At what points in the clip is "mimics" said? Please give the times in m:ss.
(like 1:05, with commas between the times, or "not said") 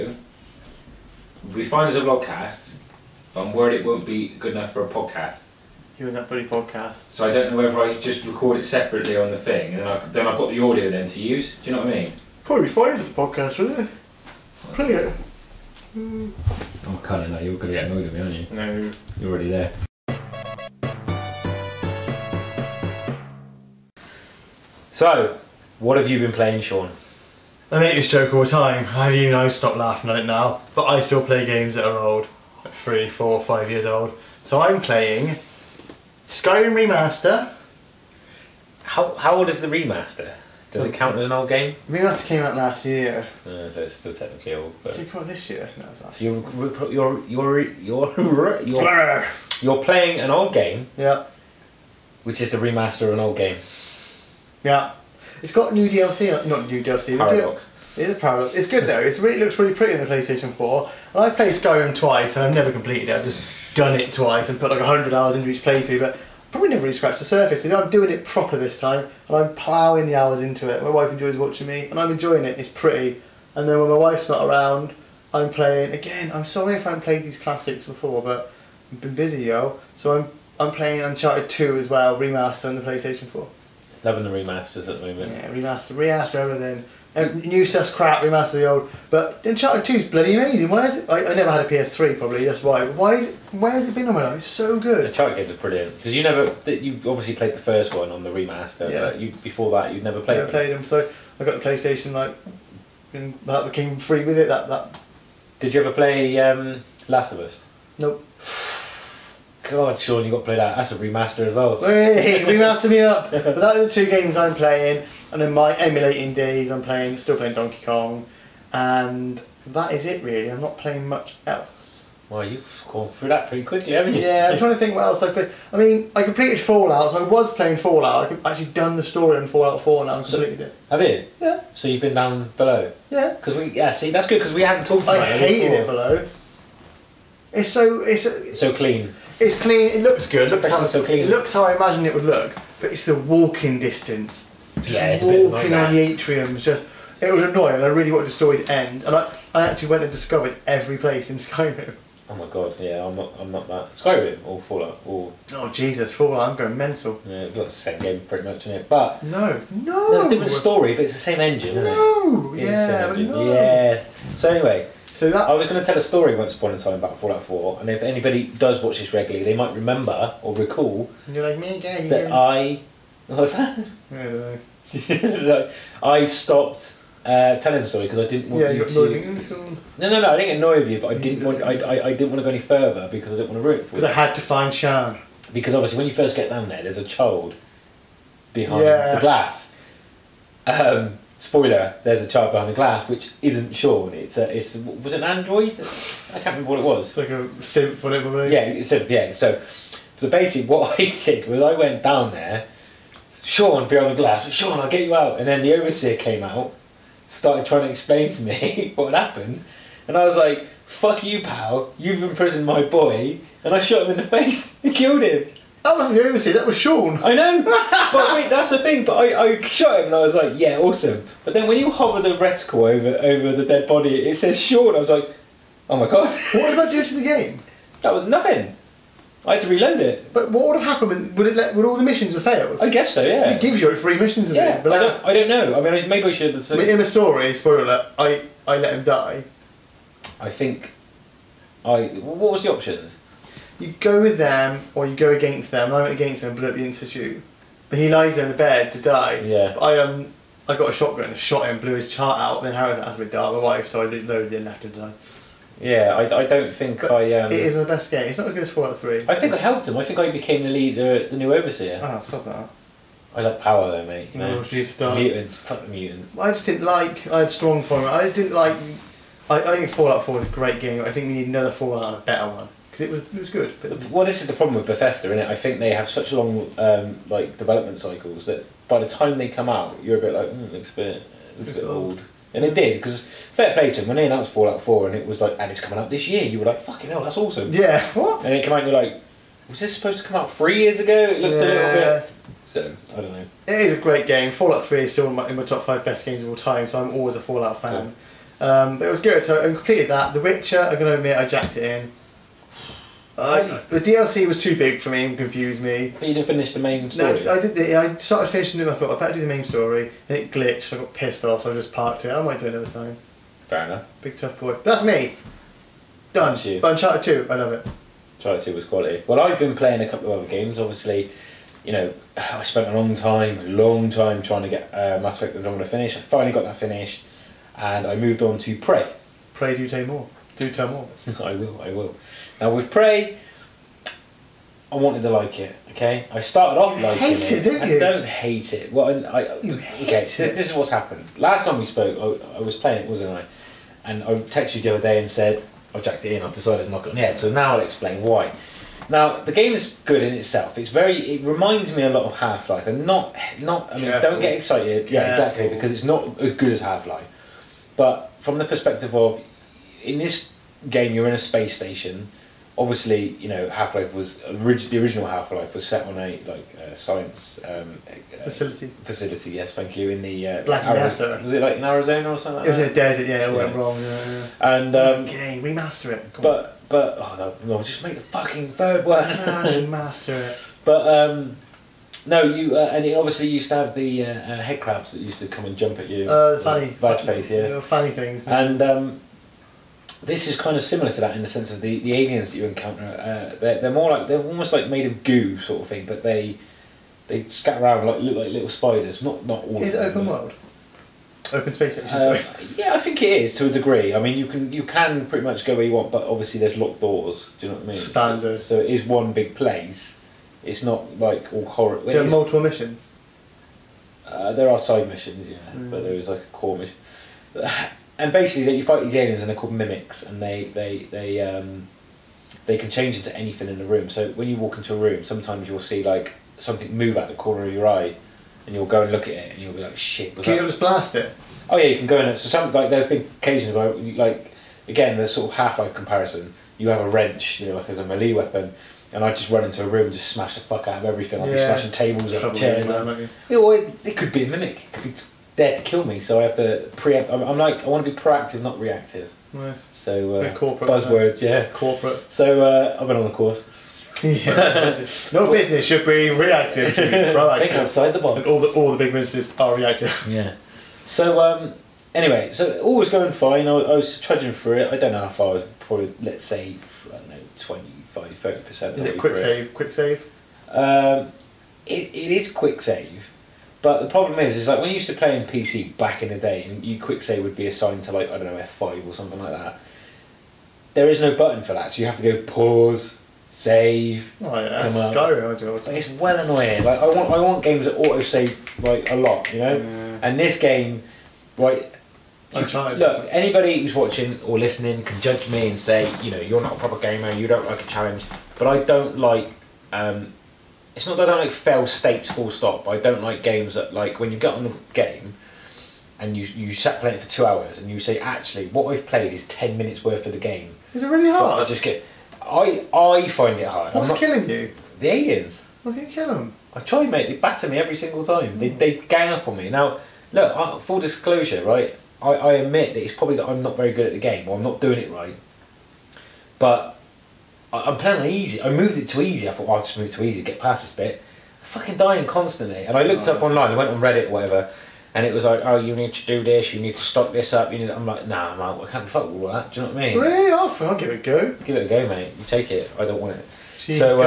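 6:59, 7:24.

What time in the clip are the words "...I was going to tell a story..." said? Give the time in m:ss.
2:45.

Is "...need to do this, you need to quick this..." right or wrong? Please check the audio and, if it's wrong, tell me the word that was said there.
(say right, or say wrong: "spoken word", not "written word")
wrong: "stock", not "quick".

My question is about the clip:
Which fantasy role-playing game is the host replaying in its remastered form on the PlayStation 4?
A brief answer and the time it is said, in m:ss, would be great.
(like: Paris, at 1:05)
Skyrim Remaster, at 0:36.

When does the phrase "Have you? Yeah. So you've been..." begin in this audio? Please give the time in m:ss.
2:10.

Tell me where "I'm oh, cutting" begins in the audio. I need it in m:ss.
0:16.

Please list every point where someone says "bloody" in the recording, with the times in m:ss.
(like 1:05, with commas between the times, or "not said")
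0:06, 1:30.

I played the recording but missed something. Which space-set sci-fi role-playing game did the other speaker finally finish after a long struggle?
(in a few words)
Mass Effect Andromeda.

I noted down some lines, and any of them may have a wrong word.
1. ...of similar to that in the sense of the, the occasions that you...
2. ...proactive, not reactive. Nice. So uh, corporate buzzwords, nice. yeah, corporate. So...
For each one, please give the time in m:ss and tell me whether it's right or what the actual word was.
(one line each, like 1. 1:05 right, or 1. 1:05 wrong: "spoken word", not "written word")
1. 6:30 wrong: "aliens", not "occasions"
2. 7:28 right.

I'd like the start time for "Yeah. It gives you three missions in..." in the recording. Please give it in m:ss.
3:53.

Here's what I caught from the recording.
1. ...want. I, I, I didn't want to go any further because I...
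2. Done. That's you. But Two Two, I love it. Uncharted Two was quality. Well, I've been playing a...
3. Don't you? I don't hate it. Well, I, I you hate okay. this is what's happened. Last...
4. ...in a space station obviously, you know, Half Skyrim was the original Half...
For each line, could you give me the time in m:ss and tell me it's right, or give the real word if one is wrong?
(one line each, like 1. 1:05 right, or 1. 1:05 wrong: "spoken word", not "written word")
1. 3:01 right
2. 5:16 wrong: "Uncharted", not "Two"
3. 5:37 right
4. 6:01 wrong: "Life", not "Skyrim".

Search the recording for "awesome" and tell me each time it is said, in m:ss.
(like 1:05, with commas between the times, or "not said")
3:40, 4:47.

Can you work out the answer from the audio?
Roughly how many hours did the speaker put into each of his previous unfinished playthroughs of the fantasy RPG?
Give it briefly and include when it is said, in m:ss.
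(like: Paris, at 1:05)
100, at 1:04.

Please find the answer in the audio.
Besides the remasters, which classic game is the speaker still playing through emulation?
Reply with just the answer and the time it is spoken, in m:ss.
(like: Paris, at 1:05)
Donkey Kong, at 1:57.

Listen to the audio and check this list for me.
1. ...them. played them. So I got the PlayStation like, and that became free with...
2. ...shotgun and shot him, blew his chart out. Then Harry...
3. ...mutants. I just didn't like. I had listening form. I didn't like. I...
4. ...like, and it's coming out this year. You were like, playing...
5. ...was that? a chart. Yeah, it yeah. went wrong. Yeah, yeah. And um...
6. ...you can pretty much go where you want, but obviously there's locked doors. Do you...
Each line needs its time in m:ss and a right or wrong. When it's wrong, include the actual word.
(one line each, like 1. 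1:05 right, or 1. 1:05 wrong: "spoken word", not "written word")
1. 1:40 right
2. 4:10 right
3. 4:25 wrong: "strong", not "listening"
4. 4:45 wrong: "fucking", not "playing"
5. 6:12 wrong: "desert", not "chart"
6. 6:44 right.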